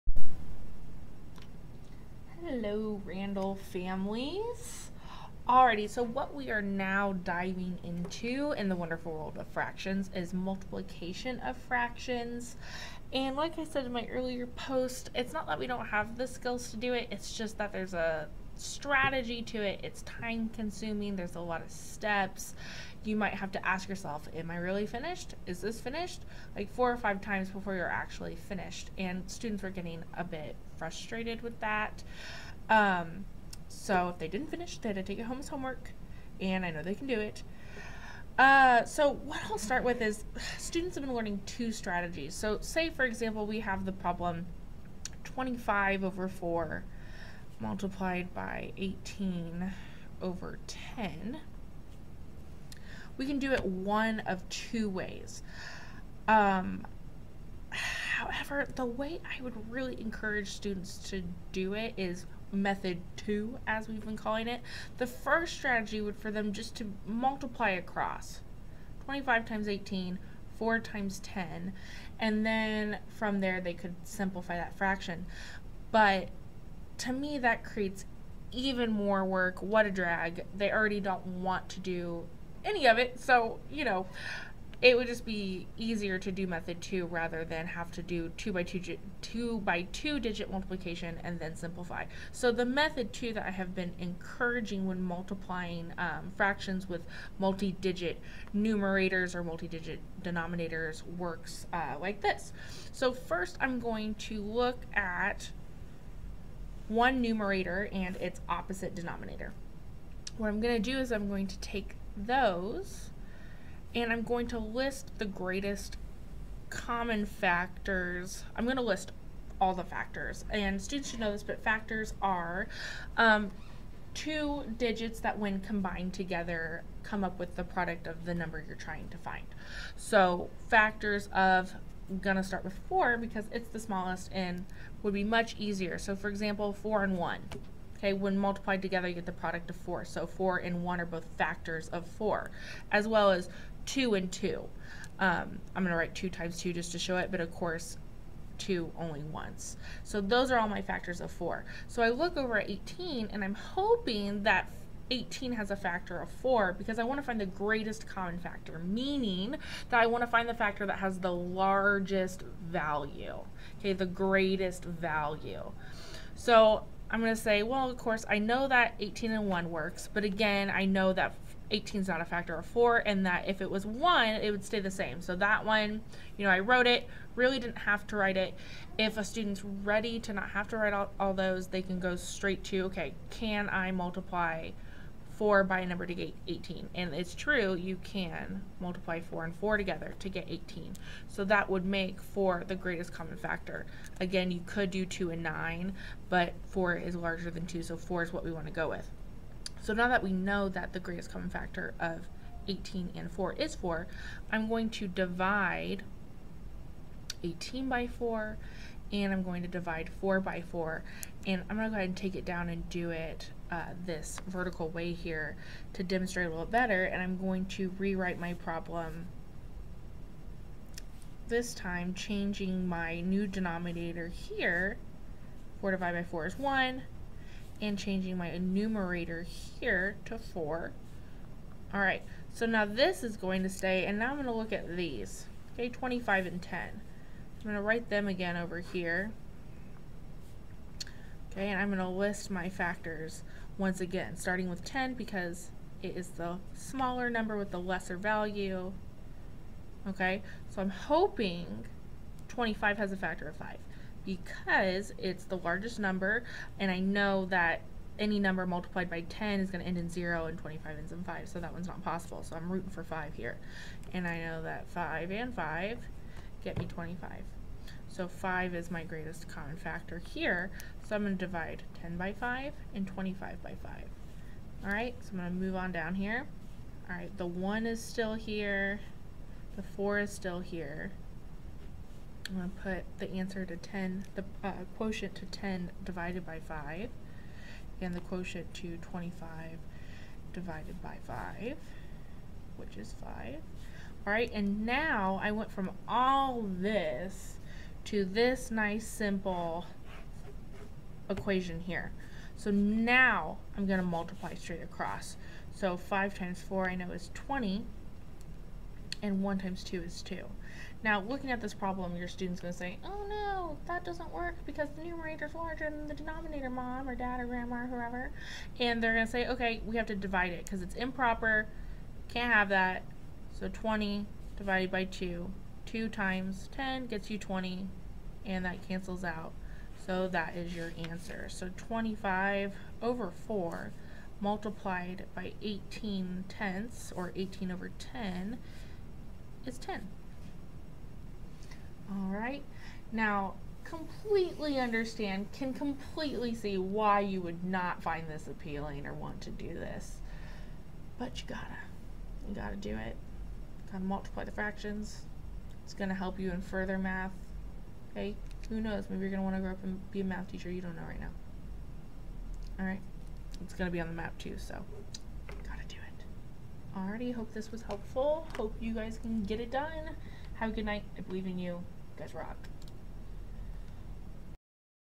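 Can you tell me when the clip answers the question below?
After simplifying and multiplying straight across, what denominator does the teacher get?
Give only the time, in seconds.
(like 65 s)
309 s.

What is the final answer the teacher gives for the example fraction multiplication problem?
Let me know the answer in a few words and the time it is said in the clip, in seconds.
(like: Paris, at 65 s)
10, at 339 s.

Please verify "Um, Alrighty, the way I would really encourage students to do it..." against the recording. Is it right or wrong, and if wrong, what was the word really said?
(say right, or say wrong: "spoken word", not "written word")
wrong: "However", not "Alrighty".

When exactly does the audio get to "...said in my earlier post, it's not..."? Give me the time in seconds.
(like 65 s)
13 s.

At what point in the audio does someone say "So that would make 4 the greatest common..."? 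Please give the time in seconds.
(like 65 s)
191 s.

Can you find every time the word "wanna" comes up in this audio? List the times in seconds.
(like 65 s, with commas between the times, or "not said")
359 s.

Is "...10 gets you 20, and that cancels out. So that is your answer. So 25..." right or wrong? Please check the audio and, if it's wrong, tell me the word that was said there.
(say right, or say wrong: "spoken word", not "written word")
right.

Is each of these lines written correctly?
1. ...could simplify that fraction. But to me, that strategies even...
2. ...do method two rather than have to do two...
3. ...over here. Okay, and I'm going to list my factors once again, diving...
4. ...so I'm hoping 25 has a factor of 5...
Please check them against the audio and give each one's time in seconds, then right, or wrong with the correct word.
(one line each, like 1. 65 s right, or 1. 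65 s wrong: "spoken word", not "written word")
1. 73 s wrong: "creates", not "strategies"
2. 86 s right
3. 238 s wrong: "starting", not "diving"
4. 250 s right.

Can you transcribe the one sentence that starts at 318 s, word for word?
And they're going to say, okay, we have to divide it because it's improper, can't have that.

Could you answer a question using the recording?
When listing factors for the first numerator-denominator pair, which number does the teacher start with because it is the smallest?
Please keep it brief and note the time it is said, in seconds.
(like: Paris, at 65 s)
4, at 132 s.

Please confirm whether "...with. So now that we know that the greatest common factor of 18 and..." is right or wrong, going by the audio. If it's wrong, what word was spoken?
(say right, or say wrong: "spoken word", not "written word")
right.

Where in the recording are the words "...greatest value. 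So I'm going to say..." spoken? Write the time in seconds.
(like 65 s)
164 s.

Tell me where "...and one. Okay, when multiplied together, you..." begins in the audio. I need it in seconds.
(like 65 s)
137 s.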